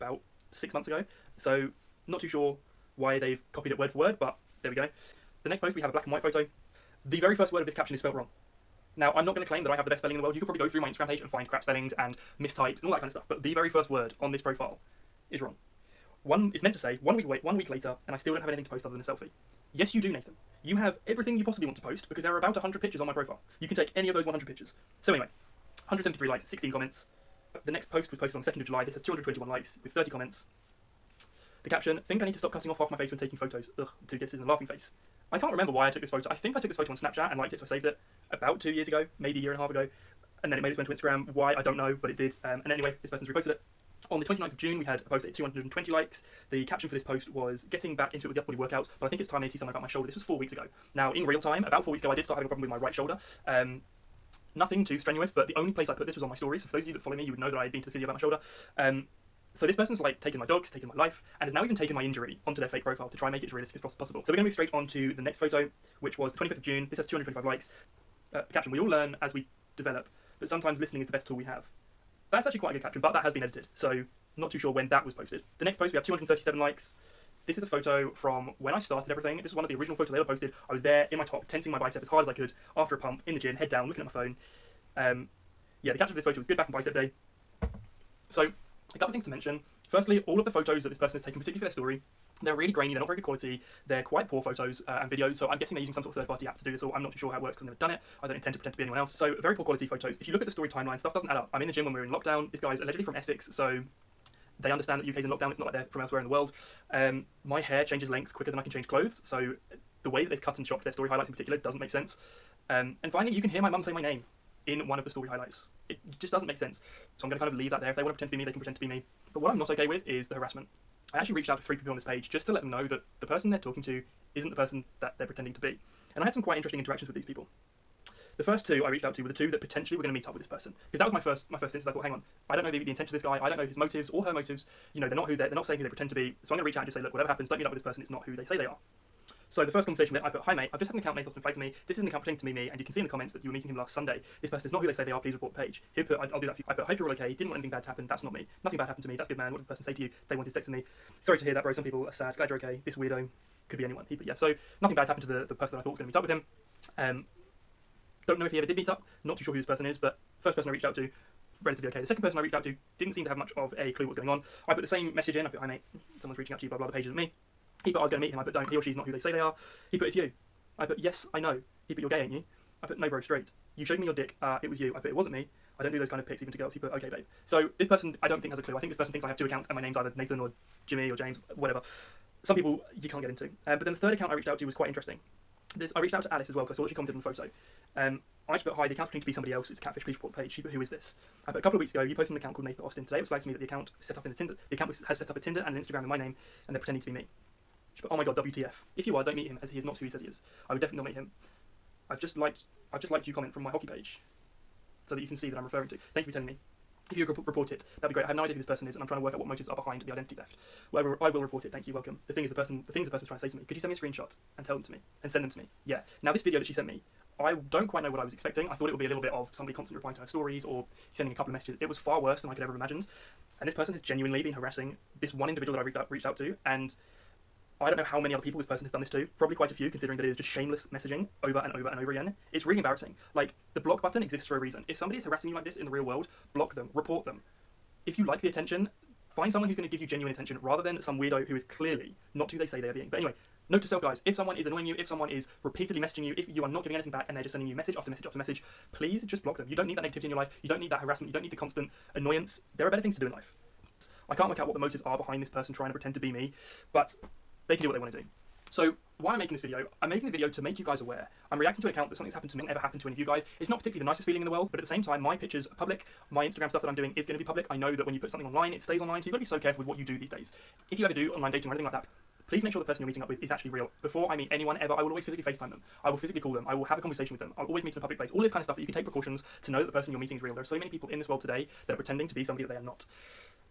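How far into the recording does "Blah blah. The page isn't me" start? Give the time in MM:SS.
02:46.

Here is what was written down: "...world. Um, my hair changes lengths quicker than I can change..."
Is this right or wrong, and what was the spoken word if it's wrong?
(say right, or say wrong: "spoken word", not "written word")
right.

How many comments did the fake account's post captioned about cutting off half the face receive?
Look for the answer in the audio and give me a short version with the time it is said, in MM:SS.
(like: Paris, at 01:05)
30, at 00:29.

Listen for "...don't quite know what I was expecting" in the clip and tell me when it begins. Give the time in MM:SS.
03:37.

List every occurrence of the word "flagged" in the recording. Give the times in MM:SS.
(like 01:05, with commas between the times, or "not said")
02:21, 03:13.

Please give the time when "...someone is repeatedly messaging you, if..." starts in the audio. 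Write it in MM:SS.
04:05.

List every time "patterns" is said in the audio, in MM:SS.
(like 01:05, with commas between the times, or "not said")
not said.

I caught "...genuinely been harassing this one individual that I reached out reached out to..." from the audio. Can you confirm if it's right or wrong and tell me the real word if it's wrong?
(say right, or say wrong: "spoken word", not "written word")
right.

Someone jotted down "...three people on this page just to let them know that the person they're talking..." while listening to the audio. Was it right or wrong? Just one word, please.
right.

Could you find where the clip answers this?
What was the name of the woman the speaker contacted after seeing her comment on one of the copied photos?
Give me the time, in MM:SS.
03:06.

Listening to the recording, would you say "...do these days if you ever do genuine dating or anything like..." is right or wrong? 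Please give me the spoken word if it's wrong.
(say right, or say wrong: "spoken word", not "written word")
wrong: "online", not "genuine".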